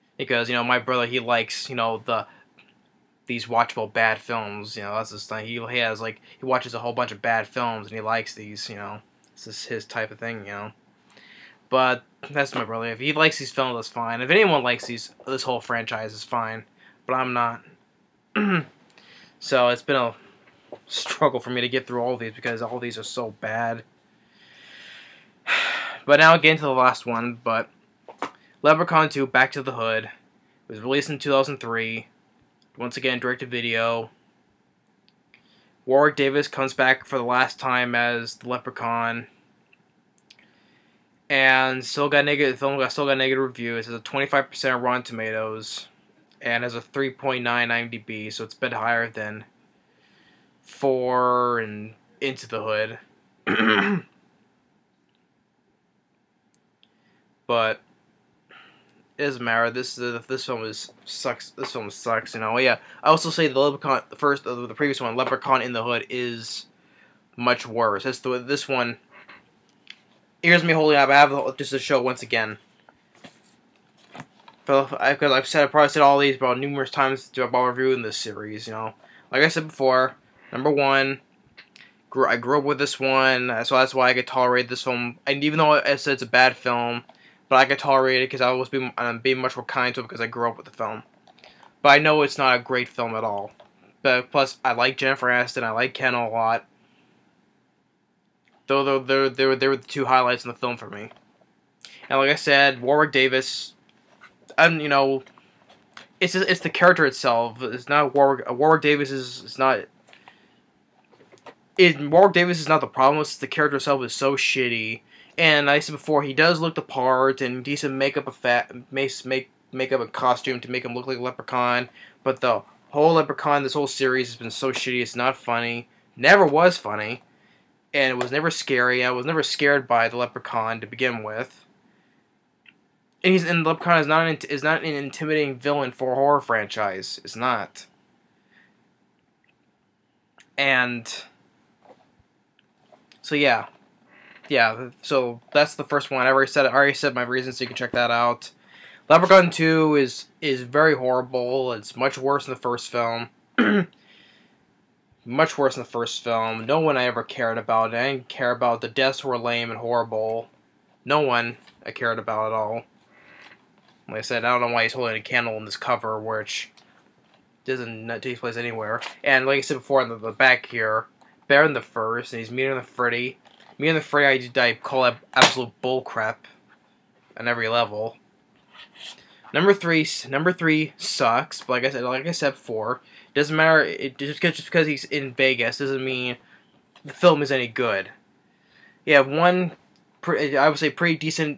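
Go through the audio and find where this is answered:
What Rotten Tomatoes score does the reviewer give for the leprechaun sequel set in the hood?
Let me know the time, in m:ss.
0:44.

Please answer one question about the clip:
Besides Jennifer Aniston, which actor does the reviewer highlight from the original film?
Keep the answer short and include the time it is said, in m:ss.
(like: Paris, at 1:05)
Ken, at 1:35.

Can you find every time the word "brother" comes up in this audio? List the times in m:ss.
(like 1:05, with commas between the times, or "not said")
0:00, 0:12.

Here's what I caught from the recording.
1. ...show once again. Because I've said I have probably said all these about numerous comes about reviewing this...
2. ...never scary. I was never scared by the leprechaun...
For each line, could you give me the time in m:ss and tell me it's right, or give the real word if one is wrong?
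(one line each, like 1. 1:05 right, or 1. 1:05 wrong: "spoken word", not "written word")
1. 1:11 wrong: "times", not "comes"
2. 2:08 right.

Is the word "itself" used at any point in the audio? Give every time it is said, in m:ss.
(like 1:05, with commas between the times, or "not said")
1:47, 1:53.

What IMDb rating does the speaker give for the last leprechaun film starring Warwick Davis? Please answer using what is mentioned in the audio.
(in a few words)
3.9.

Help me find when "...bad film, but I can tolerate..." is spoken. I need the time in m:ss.
1:26.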